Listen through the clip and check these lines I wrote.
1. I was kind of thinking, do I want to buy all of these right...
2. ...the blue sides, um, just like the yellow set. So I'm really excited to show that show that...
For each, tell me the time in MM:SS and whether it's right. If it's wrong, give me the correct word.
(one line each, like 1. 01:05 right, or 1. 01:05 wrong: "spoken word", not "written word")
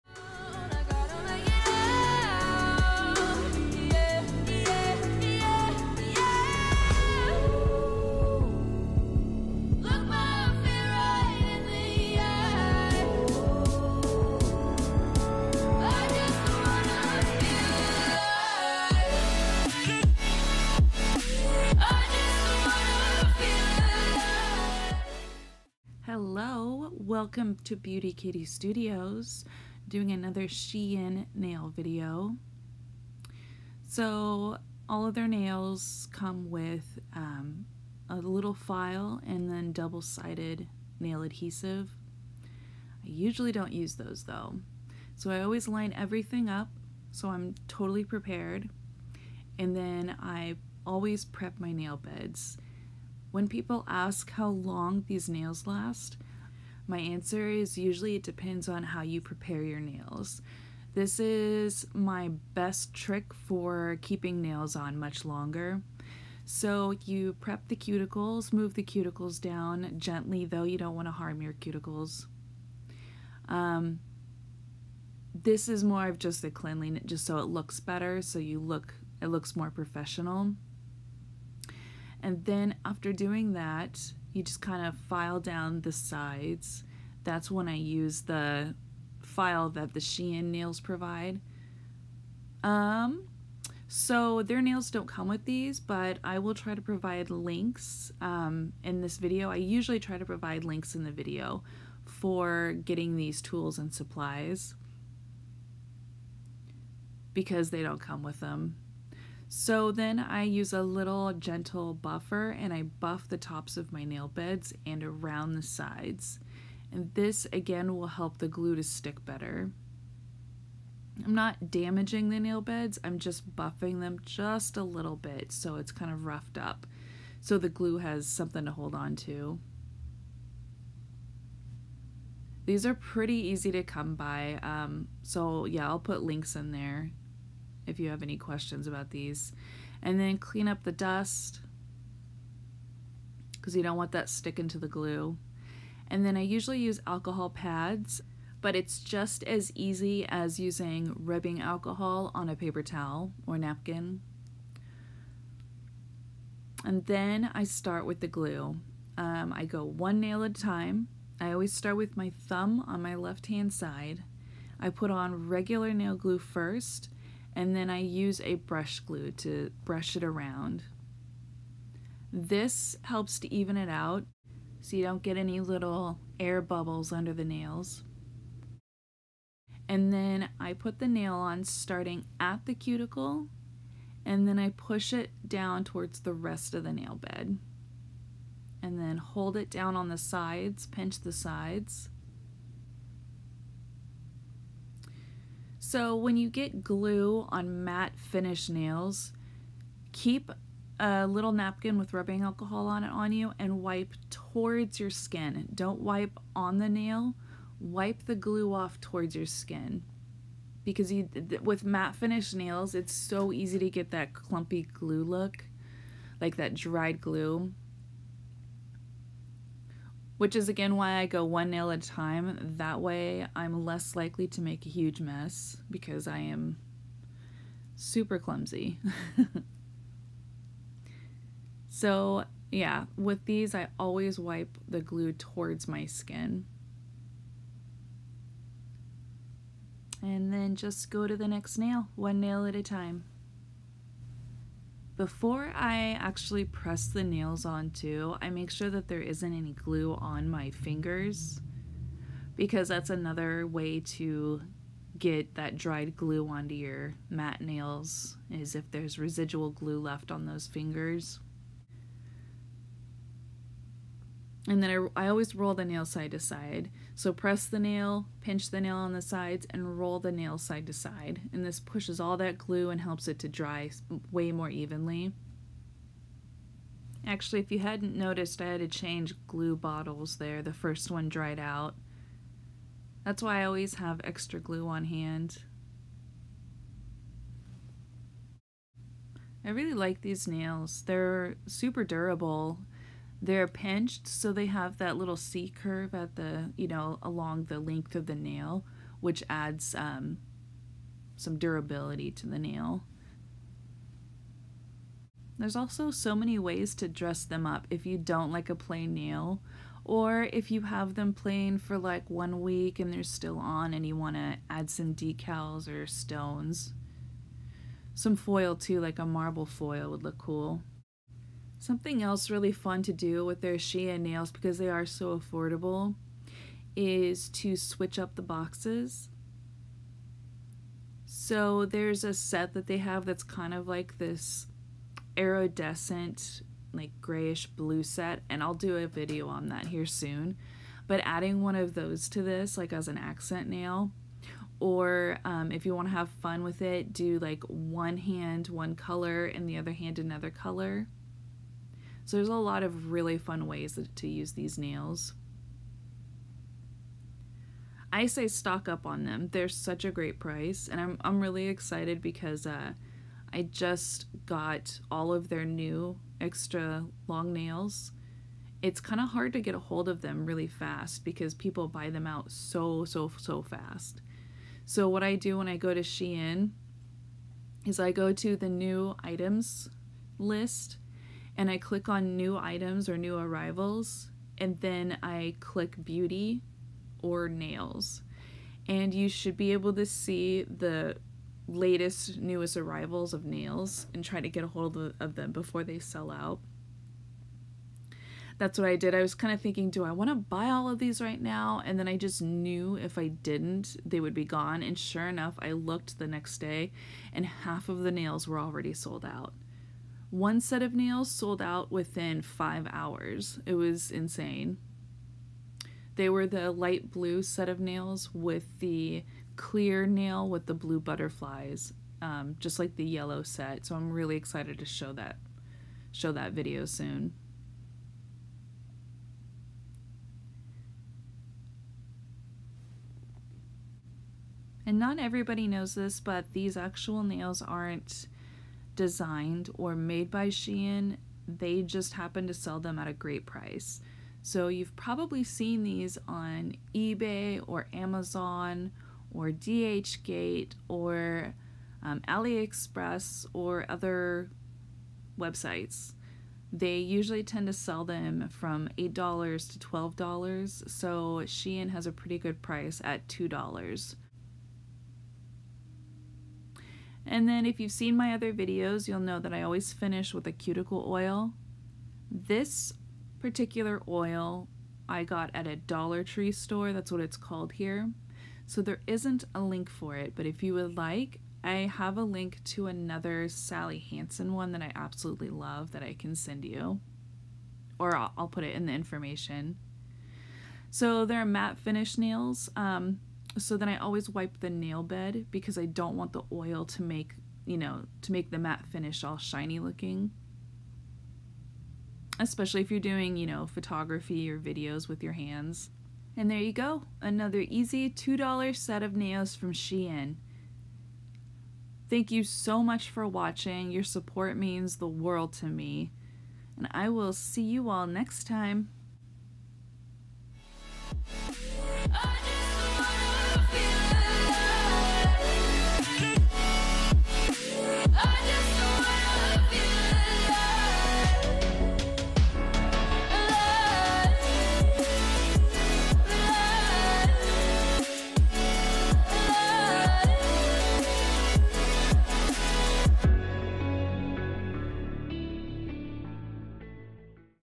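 1. 06:39 right
2. 07:00 wrong: "butterflies", not "sides".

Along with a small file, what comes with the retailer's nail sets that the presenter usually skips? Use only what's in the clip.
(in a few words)
double-sided nail adhesive.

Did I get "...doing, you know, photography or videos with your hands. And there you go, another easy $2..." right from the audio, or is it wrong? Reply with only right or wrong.
right.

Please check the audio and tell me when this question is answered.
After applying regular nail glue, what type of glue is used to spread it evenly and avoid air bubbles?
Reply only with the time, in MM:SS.
02:48.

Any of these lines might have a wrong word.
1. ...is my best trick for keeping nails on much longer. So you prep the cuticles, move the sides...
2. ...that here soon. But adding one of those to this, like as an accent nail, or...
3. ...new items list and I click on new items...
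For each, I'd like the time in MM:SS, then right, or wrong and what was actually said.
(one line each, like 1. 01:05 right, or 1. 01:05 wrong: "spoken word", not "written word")
1. 01:01 wrong: "cuticles", not "sides"
2. 05:39 right
3. 06:18 right.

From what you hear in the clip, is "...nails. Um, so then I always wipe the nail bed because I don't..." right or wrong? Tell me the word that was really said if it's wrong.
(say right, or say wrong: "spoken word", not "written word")
right.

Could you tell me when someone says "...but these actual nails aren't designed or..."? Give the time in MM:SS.
07:16.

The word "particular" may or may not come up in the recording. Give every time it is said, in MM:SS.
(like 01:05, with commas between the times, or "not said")
07:53.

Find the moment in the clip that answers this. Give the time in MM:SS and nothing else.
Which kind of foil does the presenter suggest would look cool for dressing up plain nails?
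05:19.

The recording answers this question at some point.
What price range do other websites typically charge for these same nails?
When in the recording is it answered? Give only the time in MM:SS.
07:38.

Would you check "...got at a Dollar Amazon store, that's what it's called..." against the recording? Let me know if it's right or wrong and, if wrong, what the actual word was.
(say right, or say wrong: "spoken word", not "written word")
wrong: "Tree", not "Amazon".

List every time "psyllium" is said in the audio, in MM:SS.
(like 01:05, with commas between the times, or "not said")
not said.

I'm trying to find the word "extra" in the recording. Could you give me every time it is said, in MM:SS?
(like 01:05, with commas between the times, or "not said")
04:44, 06:06.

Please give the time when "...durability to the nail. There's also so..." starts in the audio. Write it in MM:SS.
05:01.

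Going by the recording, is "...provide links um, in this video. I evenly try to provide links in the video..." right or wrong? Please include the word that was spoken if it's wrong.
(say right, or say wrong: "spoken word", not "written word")
wrong: "usually", not "evenly".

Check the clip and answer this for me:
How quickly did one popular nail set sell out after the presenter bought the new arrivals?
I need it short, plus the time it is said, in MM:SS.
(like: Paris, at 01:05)
5 hours, at 06:52.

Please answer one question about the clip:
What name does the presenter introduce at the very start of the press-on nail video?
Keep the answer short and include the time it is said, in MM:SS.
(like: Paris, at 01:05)
Beauty Kitty Studios, at 00:27.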